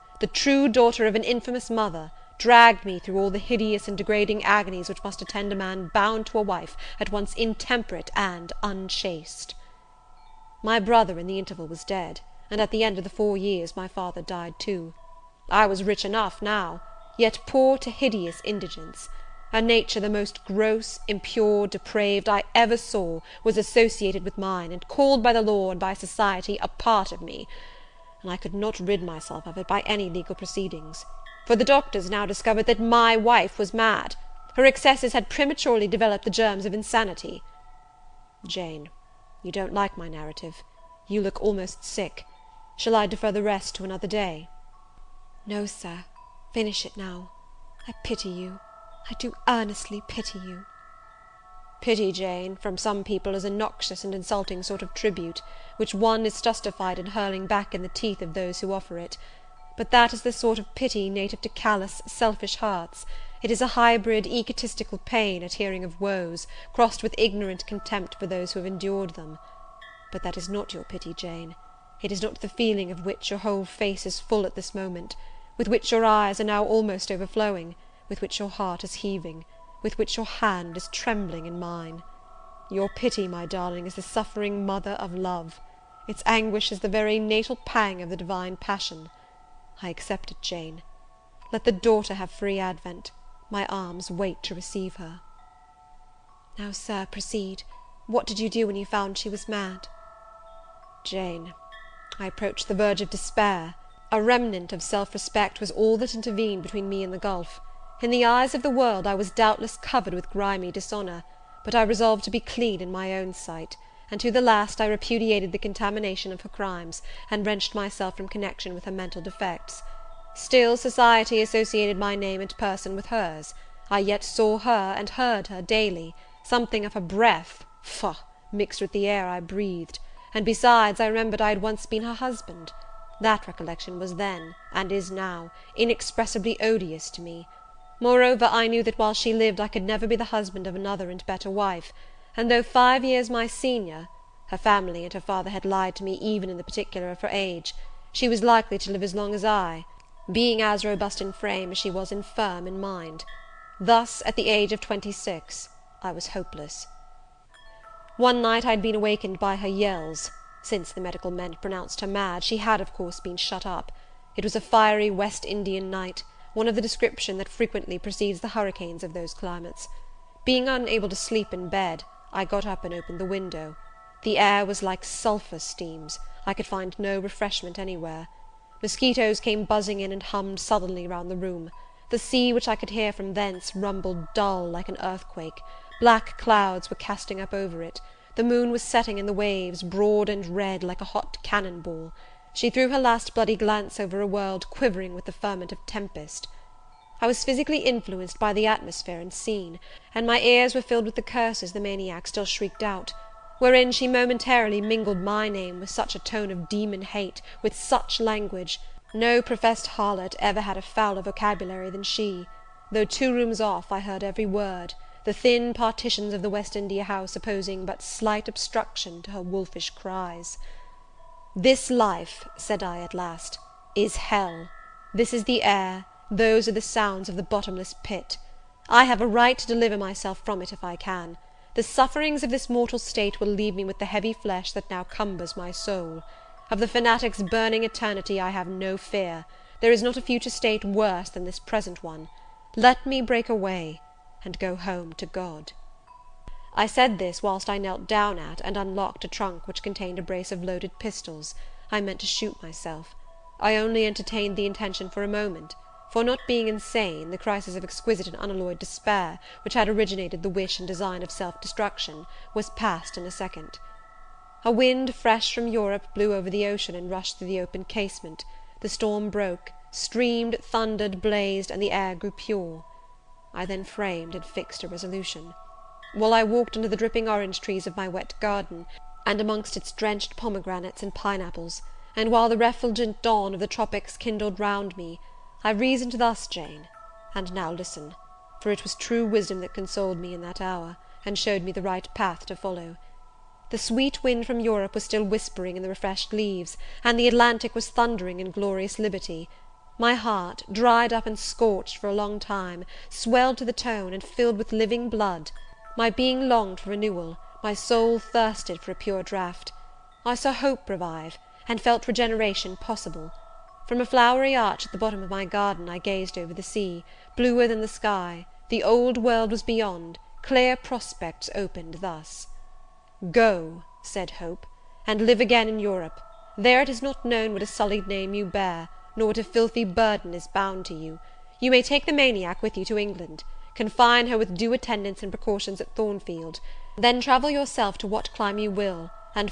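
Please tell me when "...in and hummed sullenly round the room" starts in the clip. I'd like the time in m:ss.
3:00.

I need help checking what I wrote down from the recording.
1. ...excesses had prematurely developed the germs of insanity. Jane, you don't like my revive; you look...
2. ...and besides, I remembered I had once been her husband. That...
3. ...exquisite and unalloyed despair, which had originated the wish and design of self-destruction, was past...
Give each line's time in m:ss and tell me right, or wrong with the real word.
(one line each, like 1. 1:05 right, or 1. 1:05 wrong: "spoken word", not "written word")
1. 0:34 wrong: "narrative", not "revive"
2. 2:10 right
3. 4:17 right.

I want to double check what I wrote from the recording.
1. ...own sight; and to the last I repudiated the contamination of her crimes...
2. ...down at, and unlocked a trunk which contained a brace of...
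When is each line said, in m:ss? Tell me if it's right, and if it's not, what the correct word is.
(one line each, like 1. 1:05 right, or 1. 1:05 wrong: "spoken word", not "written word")
1. 1:53 right
2. 4:08 right.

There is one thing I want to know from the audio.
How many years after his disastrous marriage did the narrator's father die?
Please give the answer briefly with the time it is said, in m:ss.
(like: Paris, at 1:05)
4, at 0:13.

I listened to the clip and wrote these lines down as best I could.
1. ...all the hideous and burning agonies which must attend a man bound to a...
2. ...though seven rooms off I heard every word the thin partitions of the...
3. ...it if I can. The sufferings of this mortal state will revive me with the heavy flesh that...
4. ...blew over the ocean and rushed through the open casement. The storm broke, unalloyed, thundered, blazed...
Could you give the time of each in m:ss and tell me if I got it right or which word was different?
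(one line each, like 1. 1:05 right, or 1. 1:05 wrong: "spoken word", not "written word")
1. 0:03 wrong: "degrading", not "burning"
2. 3:32 wrong: "two", not "seven"
3. 3:50 wrong: "leave", not "revive"
4. 4:26 wrong: "streamed", not "unalloyed".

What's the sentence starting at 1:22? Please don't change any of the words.
Your pity, my darling, is the suffering mother of love; its anguish is the very natal pang of the divine passion.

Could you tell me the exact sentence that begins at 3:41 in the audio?
"This life," said I at last, "is hell.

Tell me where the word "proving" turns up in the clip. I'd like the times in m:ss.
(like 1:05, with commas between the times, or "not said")
not said.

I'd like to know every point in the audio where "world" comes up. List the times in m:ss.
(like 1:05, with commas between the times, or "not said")
1:48, 3:14, 5:19.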